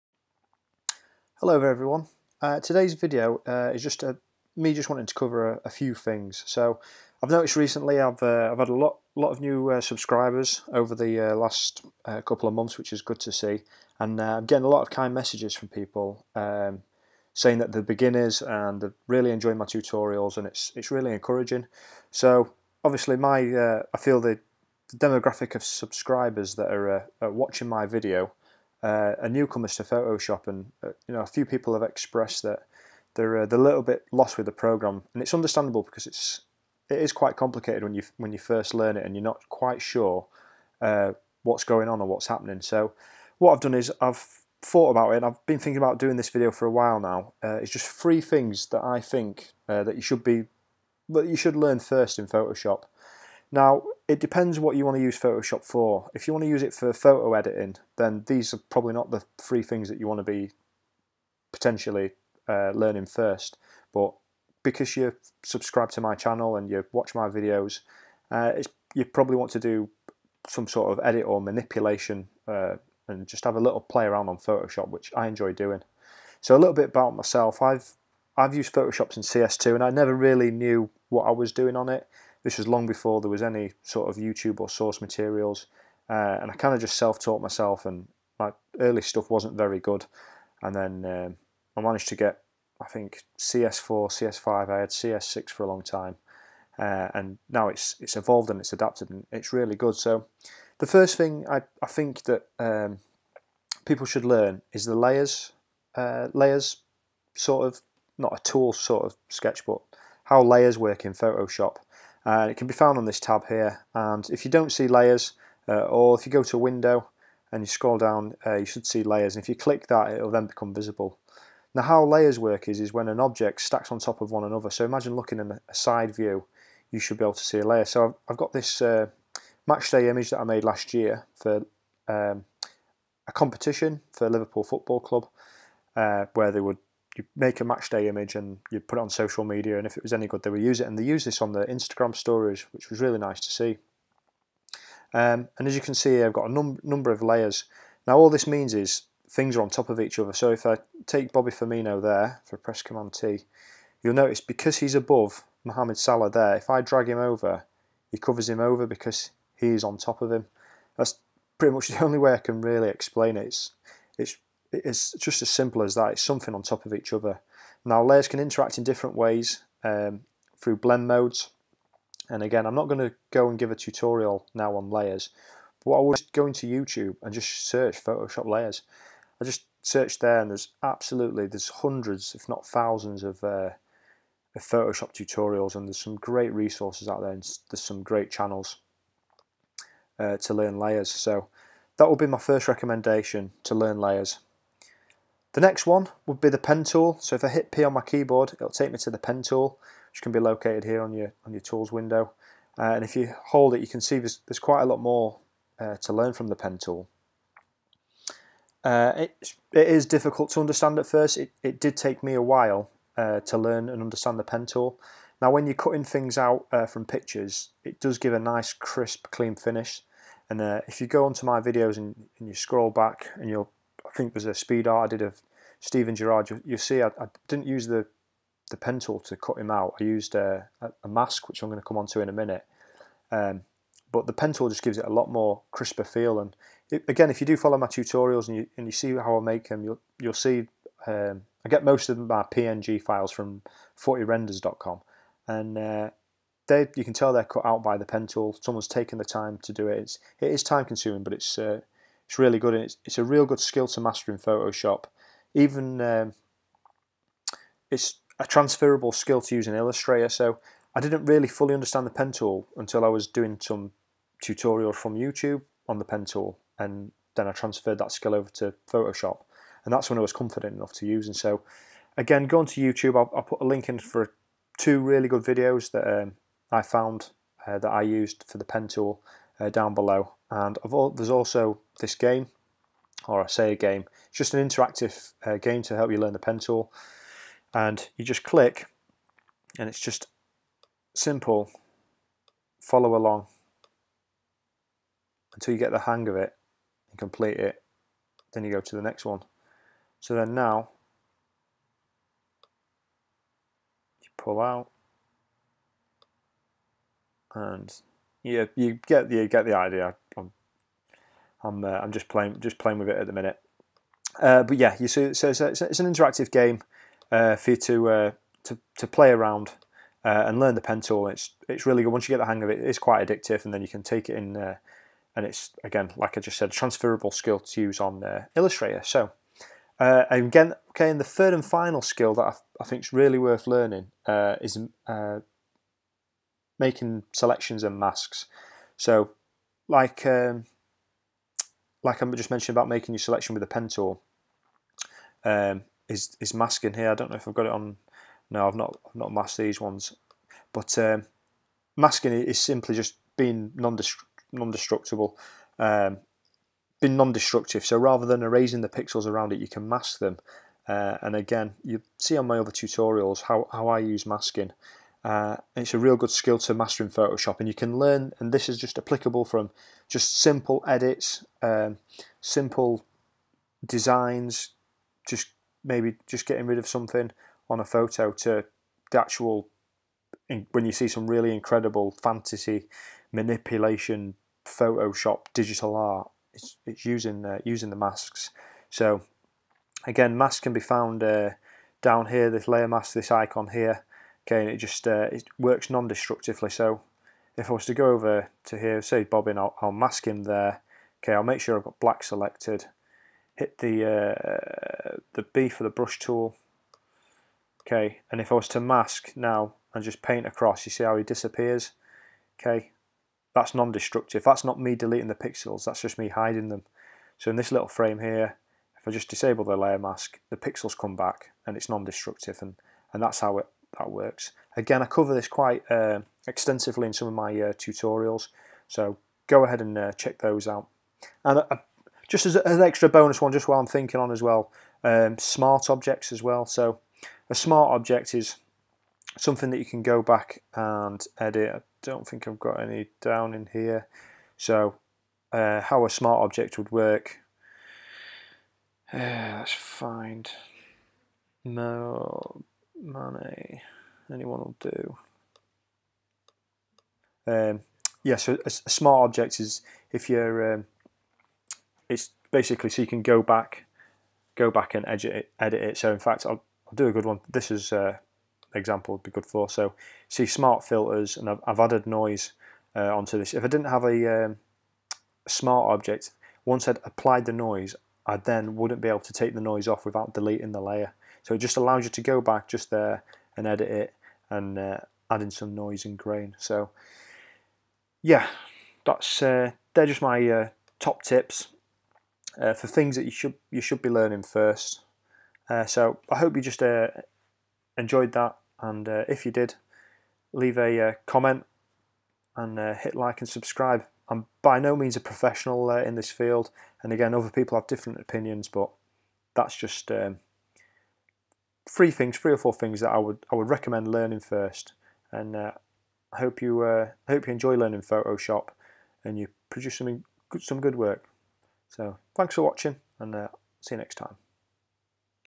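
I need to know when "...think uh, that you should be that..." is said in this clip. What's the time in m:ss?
0:48.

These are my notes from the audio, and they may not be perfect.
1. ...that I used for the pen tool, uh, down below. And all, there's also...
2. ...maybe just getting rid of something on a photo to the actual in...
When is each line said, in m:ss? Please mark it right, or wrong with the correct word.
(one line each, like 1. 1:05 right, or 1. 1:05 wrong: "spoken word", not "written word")
1. 4:37 right
2. 6:15 right.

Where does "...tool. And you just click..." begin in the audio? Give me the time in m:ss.
4:46.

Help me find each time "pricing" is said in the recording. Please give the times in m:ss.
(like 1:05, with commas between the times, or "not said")
not said.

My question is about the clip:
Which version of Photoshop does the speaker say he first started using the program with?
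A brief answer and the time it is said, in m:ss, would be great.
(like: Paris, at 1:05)
CS2, at 1:19.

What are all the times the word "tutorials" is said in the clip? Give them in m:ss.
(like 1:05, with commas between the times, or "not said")
0:19, 2:53, 3:05, 3:57, 4:24, 6:02, 7:07.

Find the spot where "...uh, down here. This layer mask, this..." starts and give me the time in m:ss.
6:31.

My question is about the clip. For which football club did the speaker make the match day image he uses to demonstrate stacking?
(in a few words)
Liverpool Football Club.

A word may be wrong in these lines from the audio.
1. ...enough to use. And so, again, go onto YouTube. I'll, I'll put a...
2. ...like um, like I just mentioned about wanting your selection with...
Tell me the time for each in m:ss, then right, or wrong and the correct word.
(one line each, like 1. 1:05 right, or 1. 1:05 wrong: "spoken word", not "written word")
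1. 4:30 right
2. 5:39 wrong: "making", not "wanting".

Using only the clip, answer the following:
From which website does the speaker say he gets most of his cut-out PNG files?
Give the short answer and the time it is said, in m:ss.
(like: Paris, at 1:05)
40renders.com, at 4:04.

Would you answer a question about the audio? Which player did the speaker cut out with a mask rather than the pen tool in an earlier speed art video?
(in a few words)
Steven Gerrard.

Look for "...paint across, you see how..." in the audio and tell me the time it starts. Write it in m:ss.
6:50.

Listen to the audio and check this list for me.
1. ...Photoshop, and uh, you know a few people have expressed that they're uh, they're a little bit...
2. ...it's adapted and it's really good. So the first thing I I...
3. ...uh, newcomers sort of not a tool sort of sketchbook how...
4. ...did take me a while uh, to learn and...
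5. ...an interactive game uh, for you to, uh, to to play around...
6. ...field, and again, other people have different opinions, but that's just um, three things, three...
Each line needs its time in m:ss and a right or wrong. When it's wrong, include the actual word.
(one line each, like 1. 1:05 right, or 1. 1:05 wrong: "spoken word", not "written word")
1. 0:29 right
2. 1:38 right
3. 1:45 wrong: "layers", not "newcomers"
4. 3:31 right
5. 5:15 right
6. 8:26 right.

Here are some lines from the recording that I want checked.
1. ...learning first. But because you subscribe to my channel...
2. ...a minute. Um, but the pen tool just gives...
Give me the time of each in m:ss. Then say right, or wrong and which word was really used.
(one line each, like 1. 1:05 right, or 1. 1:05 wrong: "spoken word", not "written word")
1. 1:02 right
2. 3:52 right.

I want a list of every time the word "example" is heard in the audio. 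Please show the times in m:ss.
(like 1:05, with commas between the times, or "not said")
7:48.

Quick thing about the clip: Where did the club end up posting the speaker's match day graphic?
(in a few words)
Instagram stories.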